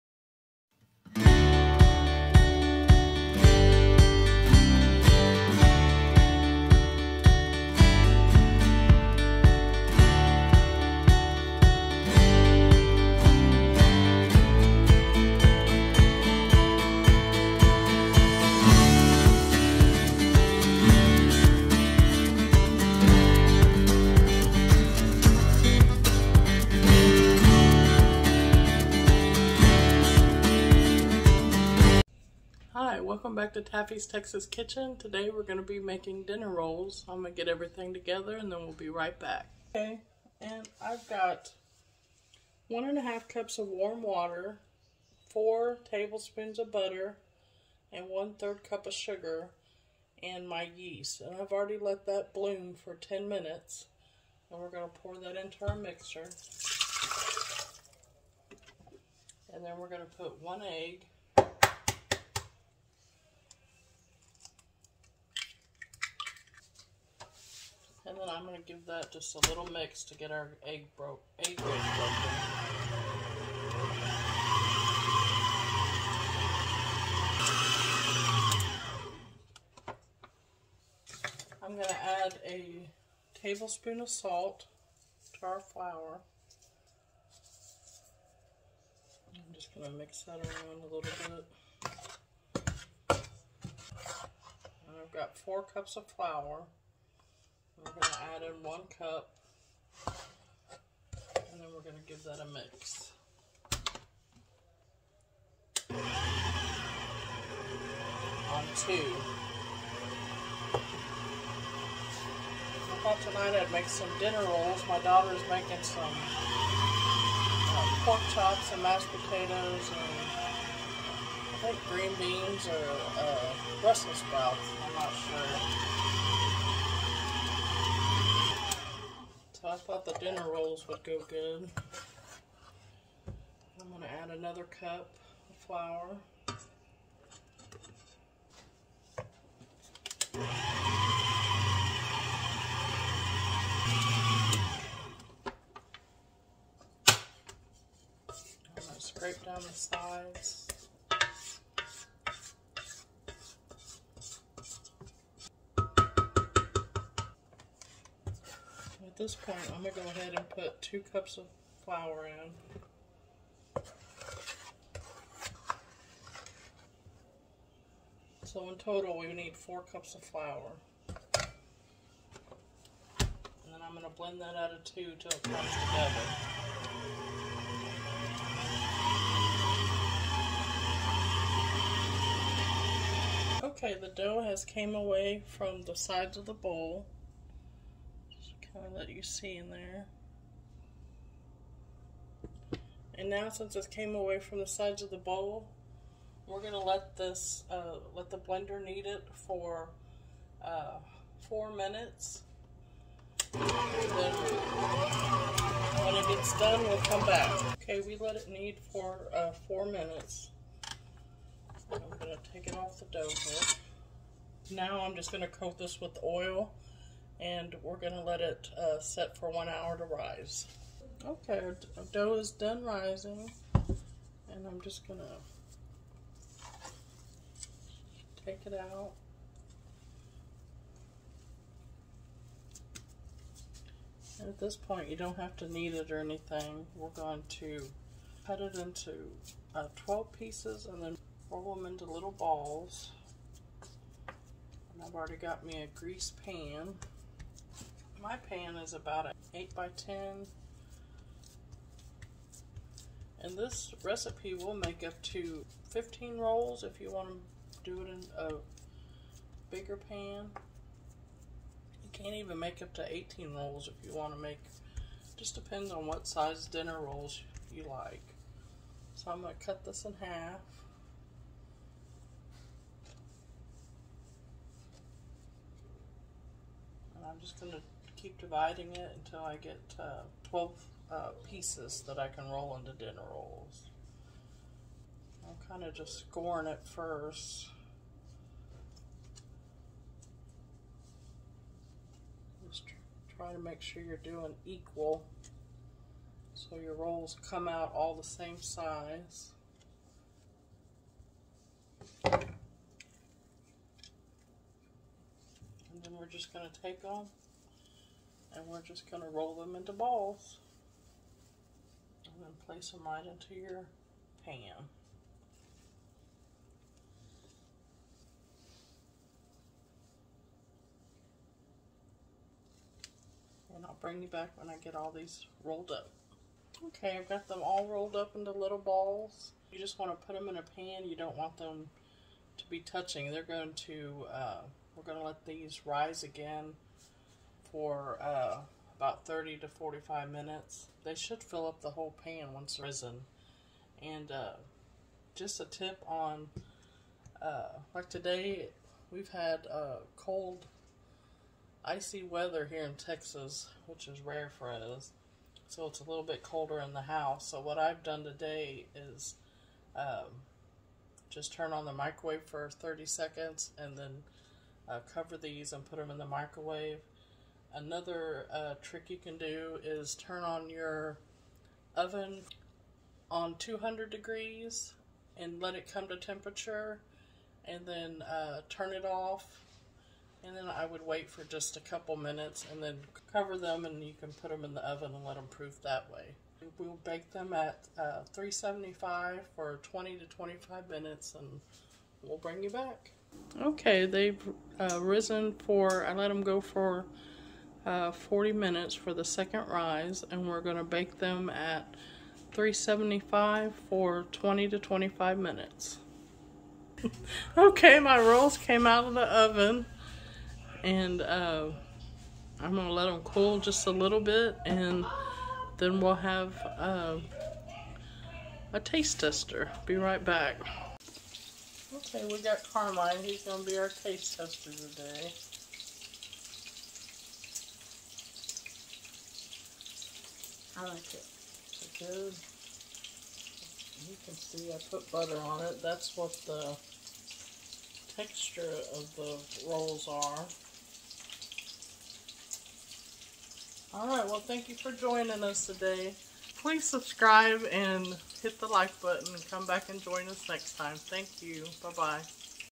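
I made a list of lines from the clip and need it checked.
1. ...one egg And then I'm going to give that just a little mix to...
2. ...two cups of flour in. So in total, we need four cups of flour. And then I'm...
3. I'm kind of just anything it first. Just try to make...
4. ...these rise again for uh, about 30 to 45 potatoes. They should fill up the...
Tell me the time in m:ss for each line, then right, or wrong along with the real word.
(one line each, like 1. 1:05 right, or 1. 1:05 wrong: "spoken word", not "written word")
1. 1:00 right
2. 2:40 right
3. 4:45 wrong: "scoring", not "anything"
4. 5:35 wrong: "minutes", not "potatoes".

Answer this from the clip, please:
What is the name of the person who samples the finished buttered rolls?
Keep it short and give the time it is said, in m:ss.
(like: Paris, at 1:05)
Carmine, at 7:02.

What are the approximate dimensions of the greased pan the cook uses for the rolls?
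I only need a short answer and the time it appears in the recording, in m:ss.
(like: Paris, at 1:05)
8 by 10, at 4:09.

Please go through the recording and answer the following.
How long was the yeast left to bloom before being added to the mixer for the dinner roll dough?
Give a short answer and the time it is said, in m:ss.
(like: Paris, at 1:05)
10 minutes, at 0:52.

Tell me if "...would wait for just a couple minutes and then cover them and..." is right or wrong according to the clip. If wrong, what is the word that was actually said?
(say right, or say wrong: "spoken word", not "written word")
right.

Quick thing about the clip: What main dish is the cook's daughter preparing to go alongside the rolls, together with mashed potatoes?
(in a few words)
pork chops.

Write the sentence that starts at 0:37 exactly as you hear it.
I'm gonna get everything together and then we'll be right back.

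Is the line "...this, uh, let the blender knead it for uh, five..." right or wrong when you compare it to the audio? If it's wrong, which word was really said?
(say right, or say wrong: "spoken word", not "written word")
wrong: "four", not "five".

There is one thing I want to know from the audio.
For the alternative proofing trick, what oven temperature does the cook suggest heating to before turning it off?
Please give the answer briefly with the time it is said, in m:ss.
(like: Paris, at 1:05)
200 degrees, at 6:13.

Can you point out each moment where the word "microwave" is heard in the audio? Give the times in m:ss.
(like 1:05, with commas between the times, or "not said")
6:01, 6:06.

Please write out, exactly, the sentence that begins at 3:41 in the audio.
Okay, our dough is done rising, and I'm just going to take it out.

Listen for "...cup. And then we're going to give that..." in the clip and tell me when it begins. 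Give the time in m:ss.
1:38.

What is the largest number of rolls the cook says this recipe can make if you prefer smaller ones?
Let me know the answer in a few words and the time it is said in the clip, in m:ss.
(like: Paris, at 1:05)
18, at 4:23.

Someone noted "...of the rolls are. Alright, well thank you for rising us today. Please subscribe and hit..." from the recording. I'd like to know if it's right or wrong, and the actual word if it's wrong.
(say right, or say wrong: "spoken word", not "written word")
wrong: "joining", not "rising".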